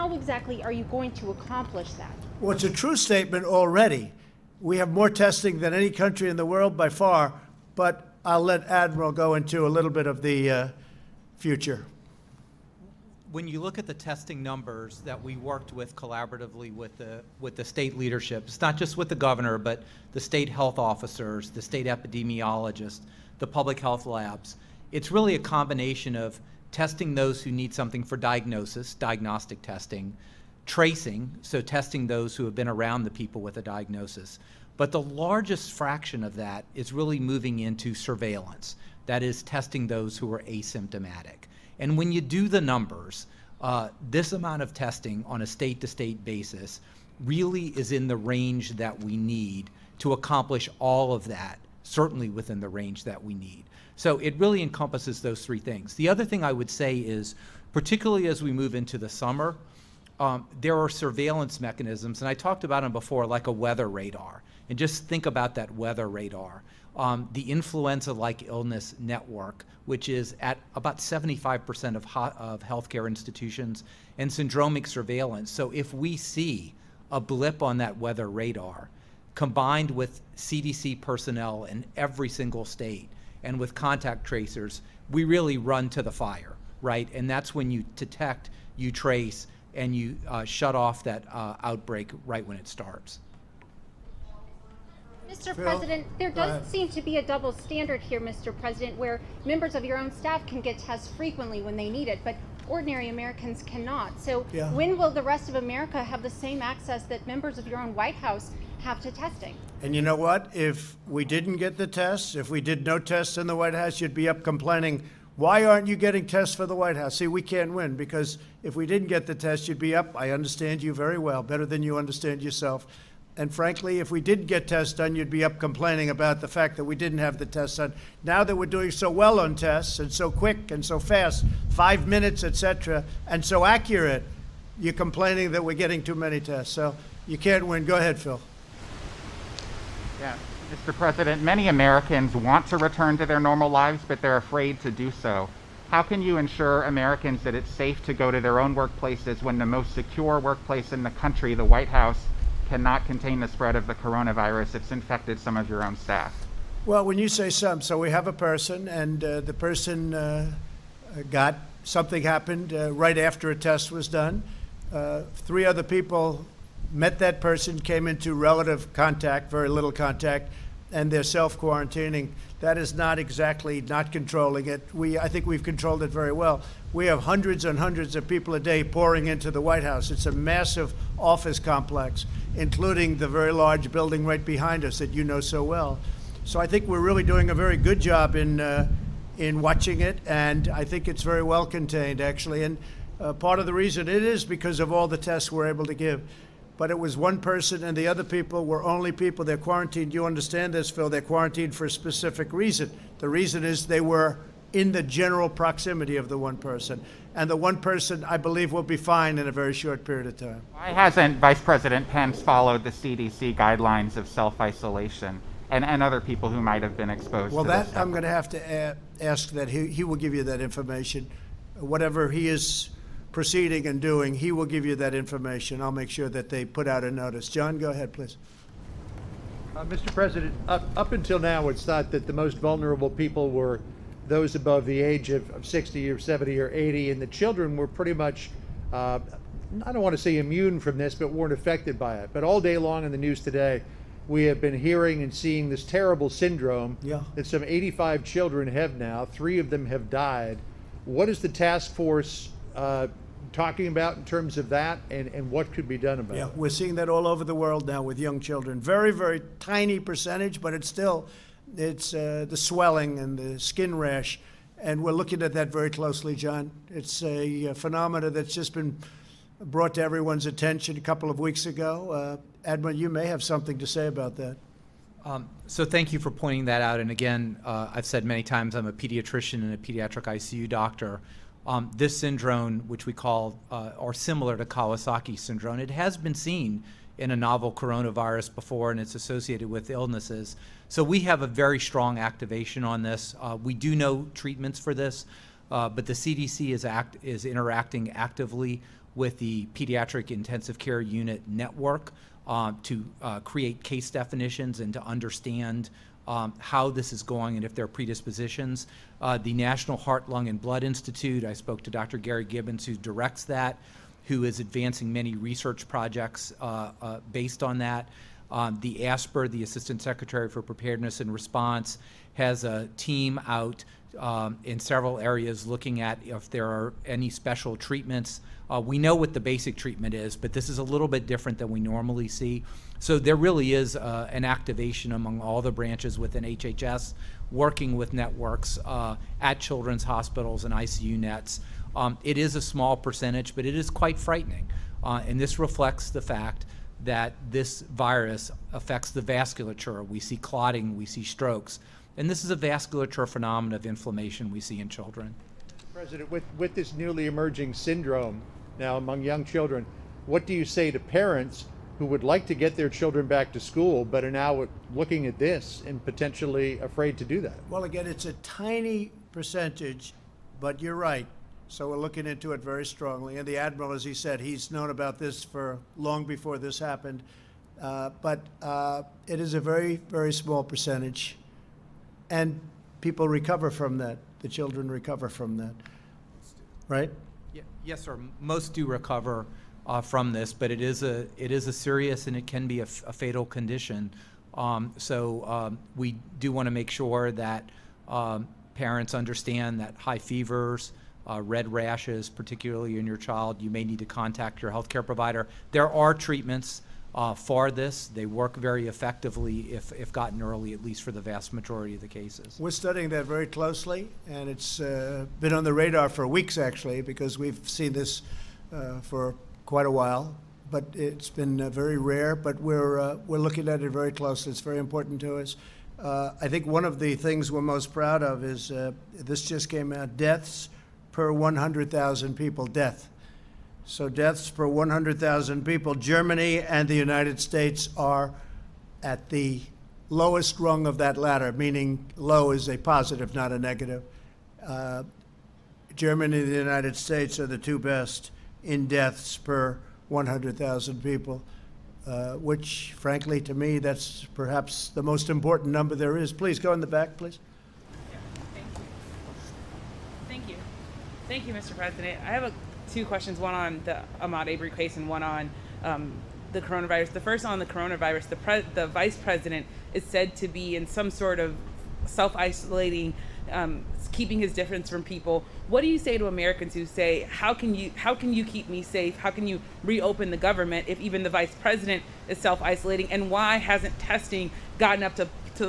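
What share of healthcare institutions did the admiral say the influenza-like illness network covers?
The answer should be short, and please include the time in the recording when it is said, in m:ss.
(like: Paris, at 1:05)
75%, at 1:10.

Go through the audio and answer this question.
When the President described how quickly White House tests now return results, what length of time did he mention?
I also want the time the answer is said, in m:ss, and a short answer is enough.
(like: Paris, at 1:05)
five minutes, at 2:11.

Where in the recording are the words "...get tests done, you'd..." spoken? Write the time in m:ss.
2:04.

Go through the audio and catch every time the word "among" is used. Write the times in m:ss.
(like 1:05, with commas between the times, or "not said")
5:35, 5:58.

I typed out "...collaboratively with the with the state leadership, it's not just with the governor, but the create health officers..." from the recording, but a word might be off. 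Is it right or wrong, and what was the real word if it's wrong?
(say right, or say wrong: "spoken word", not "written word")
wrong: "state", not "create".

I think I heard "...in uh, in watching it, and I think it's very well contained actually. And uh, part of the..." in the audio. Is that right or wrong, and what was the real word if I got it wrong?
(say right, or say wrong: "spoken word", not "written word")
right.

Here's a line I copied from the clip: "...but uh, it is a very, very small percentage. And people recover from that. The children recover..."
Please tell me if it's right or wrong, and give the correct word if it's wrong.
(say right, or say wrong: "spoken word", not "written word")
right.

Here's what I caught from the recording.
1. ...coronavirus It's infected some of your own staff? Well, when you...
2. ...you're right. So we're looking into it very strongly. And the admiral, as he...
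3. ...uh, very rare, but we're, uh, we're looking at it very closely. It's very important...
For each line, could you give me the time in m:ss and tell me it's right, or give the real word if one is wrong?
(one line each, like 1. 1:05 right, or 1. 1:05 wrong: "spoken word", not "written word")
1. 2:33 right
2. 6:10 right
3. 7:01 right.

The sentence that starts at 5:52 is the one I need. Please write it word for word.
And this is a vasculature phenomenon of inflammation we see in children.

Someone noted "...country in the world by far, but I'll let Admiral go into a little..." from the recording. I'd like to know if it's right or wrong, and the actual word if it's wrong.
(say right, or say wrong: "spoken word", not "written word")
right.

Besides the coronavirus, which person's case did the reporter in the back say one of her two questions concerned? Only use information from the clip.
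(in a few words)
Ahmaud Arbery.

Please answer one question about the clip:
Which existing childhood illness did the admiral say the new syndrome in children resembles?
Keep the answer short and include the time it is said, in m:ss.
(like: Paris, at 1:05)
Kawasaki syndrome, at 4:44.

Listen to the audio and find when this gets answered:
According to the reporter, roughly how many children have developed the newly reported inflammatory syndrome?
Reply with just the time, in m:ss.
4:07.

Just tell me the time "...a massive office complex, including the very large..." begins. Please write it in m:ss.
3:00.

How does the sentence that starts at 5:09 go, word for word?
Uh, the National Heart, Lung, and Blood Institute, I spoke to Dr.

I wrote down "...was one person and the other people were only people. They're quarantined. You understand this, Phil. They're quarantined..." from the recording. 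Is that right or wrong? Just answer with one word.
right.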